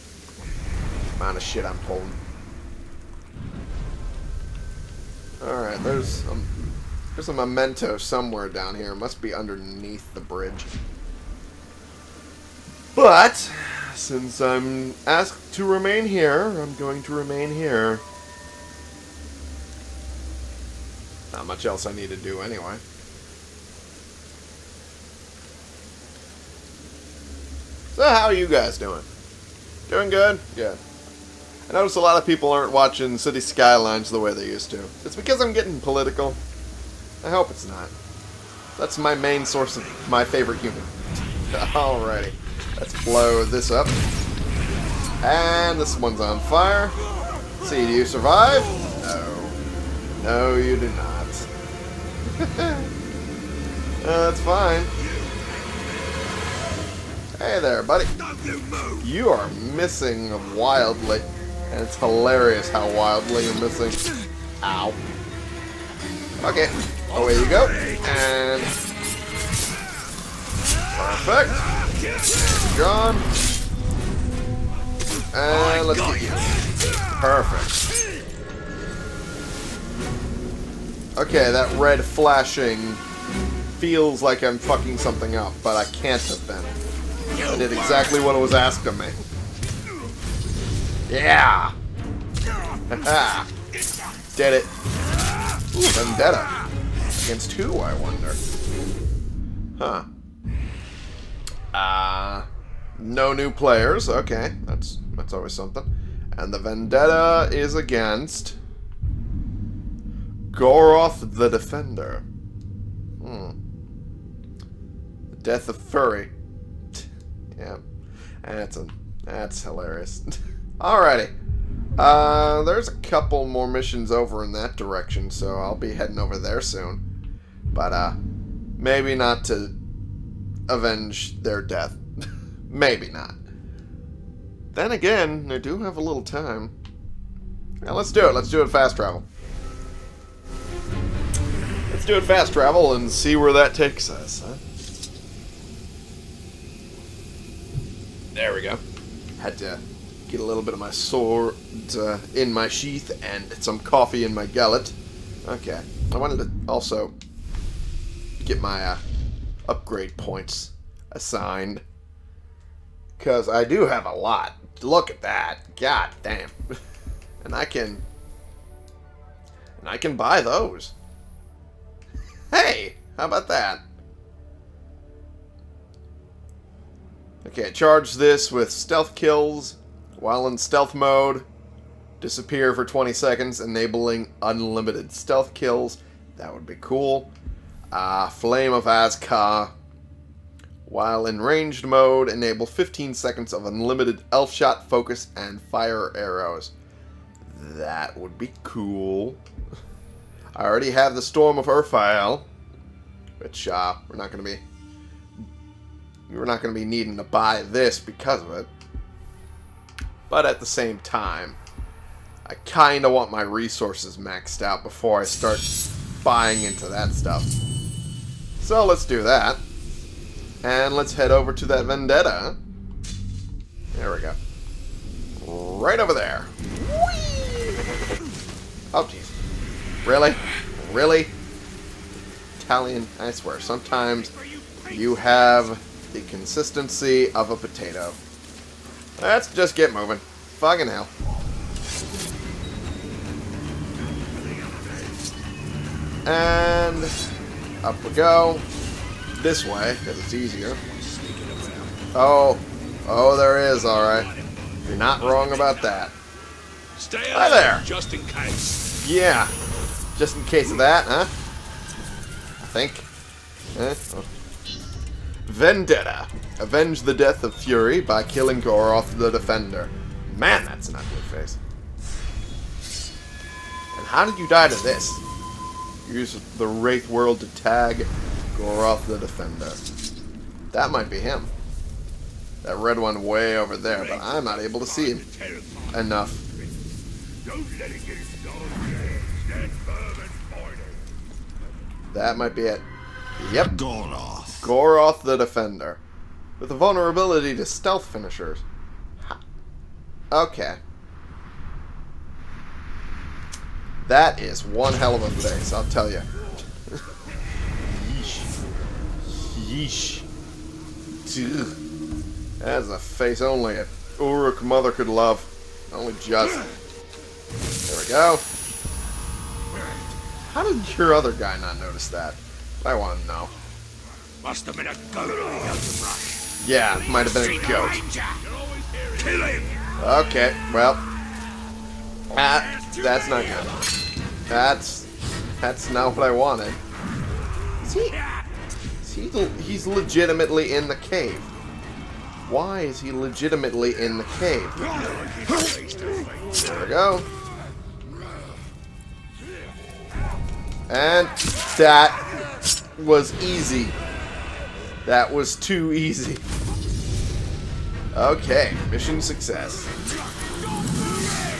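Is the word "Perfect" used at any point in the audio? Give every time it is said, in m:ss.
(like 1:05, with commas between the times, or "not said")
1:10, 1:17.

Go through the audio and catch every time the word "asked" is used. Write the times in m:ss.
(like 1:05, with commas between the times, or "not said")
0:15, 1:28.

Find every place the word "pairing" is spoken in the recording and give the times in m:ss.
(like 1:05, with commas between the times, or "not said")
not said.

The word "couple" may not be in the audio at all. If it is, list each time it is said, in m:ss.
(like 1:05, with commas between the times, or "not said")
2:02.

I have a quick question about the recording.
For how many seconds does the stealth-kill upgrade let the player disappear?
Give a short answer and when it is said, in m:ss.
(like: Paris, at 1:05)
20, at 3:02.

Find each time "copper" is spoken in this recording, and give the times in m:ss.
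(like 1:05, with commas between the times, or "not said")
not said.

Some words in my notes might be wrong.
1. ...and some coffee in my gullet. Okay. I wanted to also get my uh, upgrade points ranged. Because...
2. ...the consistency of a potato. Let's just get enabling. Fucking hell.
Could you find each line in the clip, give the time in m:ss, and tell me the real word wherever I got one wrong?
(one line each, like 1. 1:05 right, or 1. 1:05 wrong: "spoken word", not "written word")
1. 2:33 wrong: "assigned", not "ranged"
2. 3:56 wrong: "moving", not "enabling".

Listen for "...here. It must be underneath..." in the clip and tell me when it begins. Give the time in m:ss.
0:08.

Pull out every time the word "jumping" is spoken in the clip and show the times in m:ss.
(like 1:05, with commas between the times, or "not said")
not said.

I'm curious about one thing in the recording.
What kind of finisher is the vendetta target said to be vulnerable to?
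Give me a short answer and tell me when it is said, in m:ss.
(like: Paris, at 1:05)
stealth finishers, at 4:57.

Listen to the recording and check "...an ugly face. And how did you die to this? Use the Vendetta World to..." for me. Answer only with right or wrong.
wrong.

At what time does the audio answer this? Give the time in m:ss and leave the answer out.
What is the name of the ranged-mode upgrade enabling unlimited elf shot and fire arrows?
3:08.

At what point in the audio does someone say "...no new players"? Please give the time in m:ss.
1:42.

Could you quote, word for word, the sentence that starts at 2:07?
But, uh, maybe not to avenge their death.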